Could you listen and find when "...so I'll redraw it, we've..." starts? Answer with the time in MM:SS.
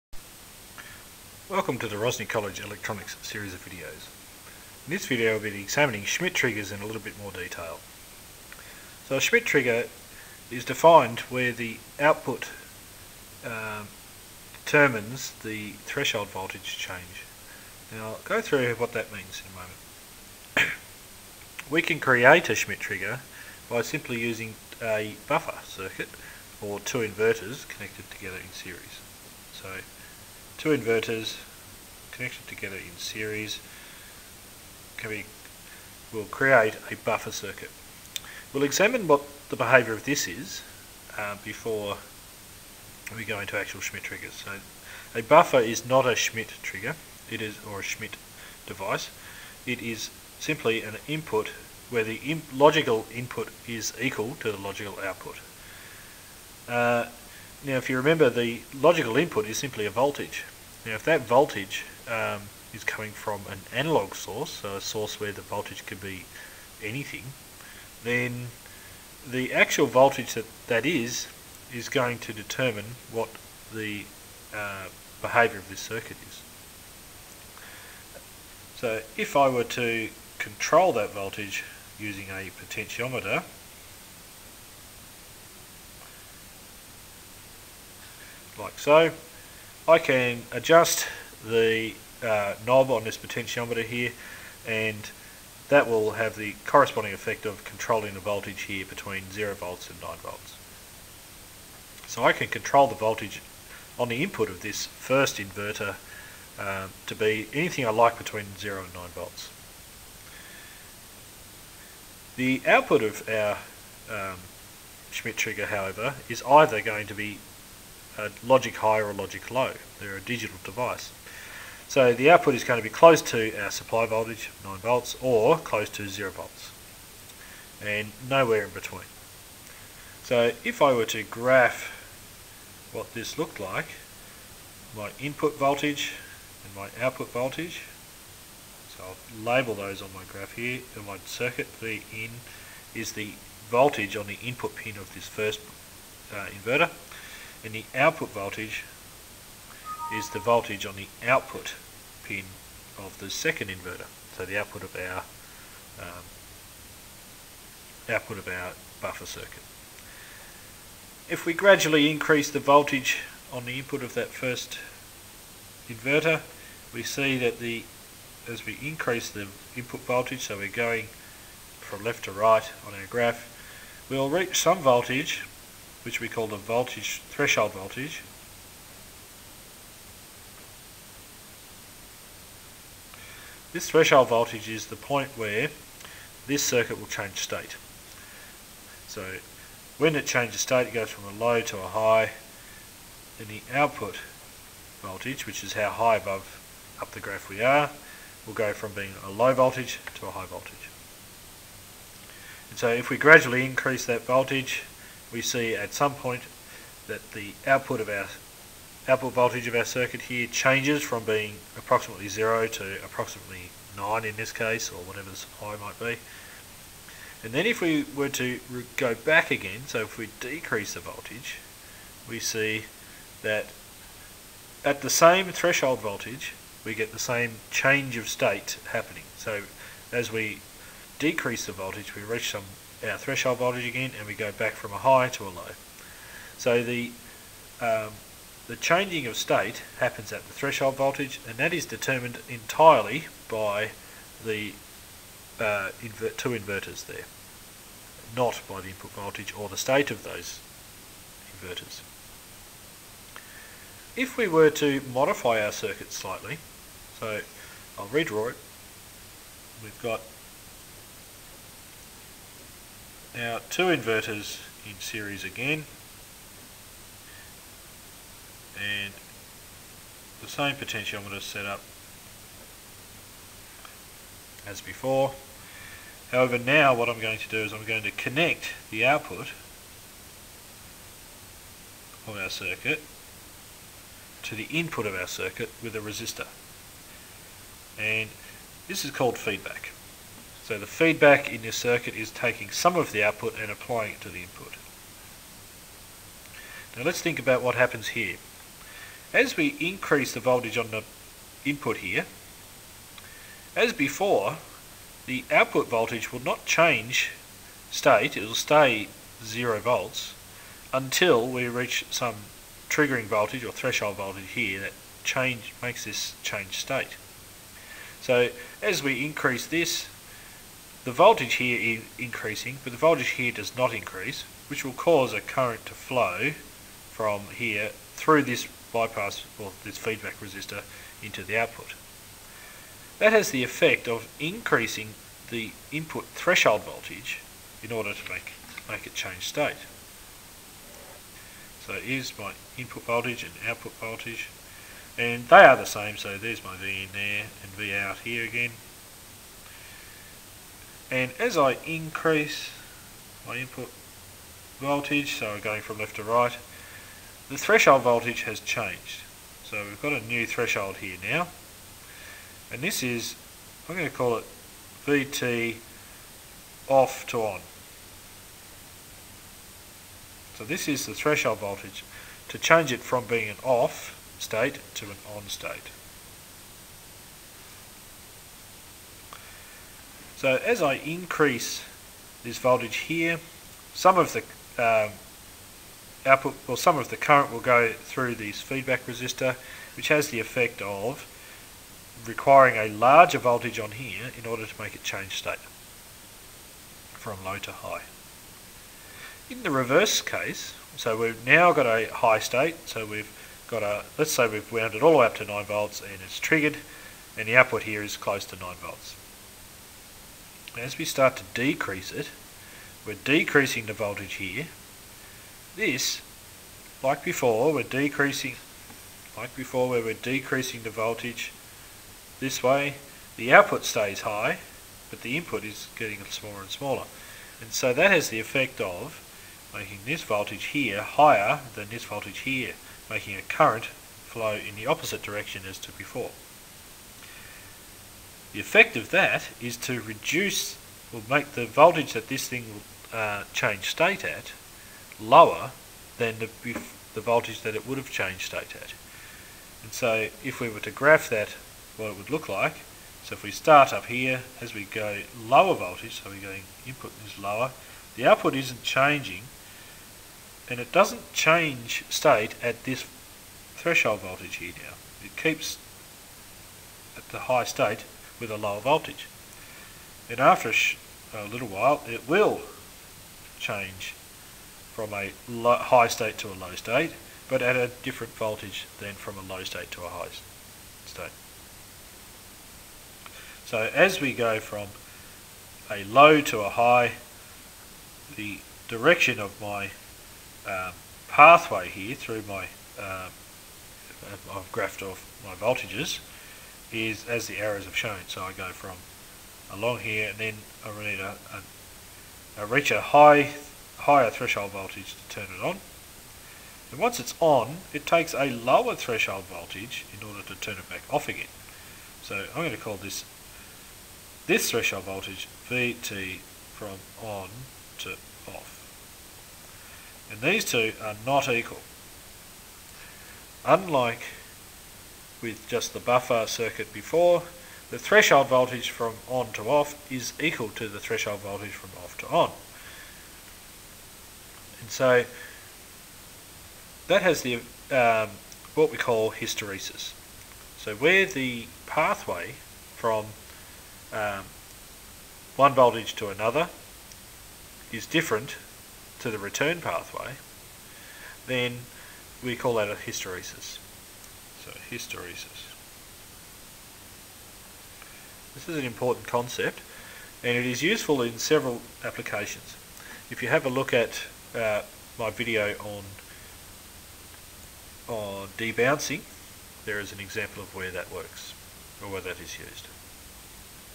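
04:17.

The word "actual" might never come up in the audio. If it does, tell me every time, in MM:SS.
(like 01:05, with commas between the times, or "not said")
00:43, 01:09.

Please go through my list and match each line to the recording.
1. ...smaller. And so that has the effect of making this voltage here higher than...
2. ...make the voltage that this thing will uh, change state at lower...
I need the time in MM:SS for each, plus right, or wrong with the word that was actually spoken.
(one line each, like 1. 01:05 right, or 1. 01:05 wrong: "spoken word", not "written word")
1. 07:06 right
2. 07:21 right.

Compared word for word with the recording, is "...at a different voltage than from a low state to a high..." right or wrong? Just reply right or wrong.
right.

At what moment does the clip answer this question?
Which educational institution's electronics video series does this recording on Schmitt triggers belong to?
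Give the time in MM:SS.
00:01.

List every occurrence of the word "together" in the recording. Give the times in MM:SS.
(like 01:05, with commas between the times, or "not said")
00:28, 00:32.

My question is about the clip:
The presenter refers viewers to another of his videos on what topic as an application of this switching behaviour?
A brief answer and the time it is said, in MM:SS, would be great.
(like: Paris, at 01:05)
debouncing, at 09:28.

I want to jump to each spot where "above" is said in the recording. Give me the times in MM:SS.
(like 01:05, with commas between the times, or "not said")
03:16.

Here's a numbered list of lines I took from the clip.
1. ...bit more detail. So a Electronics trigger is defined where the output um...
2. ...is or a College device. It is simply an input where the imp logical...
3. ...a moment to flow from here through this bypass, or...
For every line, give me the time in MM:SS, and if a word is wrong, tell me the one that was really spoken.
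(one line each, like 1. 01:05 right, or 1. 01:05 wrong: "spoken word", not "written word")
1. 00:07 wrong: "Schmitt", not "Electronics"
2. 00:47 wrong: "Schmitt", not "College"
3. 05:25 wrong: "current", not "moment".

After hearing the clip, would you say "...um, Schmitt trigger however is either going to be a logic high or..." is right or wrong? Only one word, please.
right.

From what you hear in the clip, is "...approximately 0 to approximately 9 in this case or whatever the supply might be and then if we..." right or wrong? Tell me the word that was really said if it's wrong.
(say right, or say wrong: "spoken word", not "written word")
right.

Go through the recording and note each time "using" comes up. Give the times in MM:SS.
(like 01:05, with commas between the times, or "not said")
00:24, 01:21.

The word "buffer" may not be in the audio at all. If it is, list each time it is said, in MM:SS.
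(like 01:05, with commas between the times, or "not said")
00:25, 00:36, 00:45, 02:39, 08:45.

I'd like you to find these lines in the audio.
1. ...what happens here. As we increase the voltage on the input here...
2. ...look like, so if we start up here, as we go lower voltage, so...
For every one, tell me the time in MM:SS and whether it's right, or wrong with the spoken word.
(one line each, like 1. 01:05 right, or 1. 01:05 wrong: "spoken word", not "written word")
1. 04:57 right
2. 07:32 right.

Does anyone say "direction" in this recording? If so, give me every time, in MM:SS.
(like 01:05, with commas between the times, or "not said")
07:15, 08:08.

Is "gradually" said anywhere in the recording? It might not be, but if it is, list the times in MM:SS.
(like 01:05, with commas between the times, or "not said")
02:41, 03:23.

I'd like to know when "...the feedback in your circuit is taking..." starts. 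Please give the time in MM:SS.
04:50.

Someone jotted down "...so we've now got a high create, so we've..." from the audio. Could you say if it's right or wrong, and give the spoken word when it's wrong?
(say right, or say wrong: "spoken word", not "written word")
wrong: "state", not "create".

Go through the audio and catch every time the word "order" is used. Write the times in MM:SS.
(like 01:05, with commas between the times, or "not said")
05:37, 06:34, 08:30.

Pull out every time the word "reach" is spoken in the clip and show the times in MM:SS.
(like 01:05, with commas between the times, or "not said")
02:54, 03:52, 05:11, 08:22.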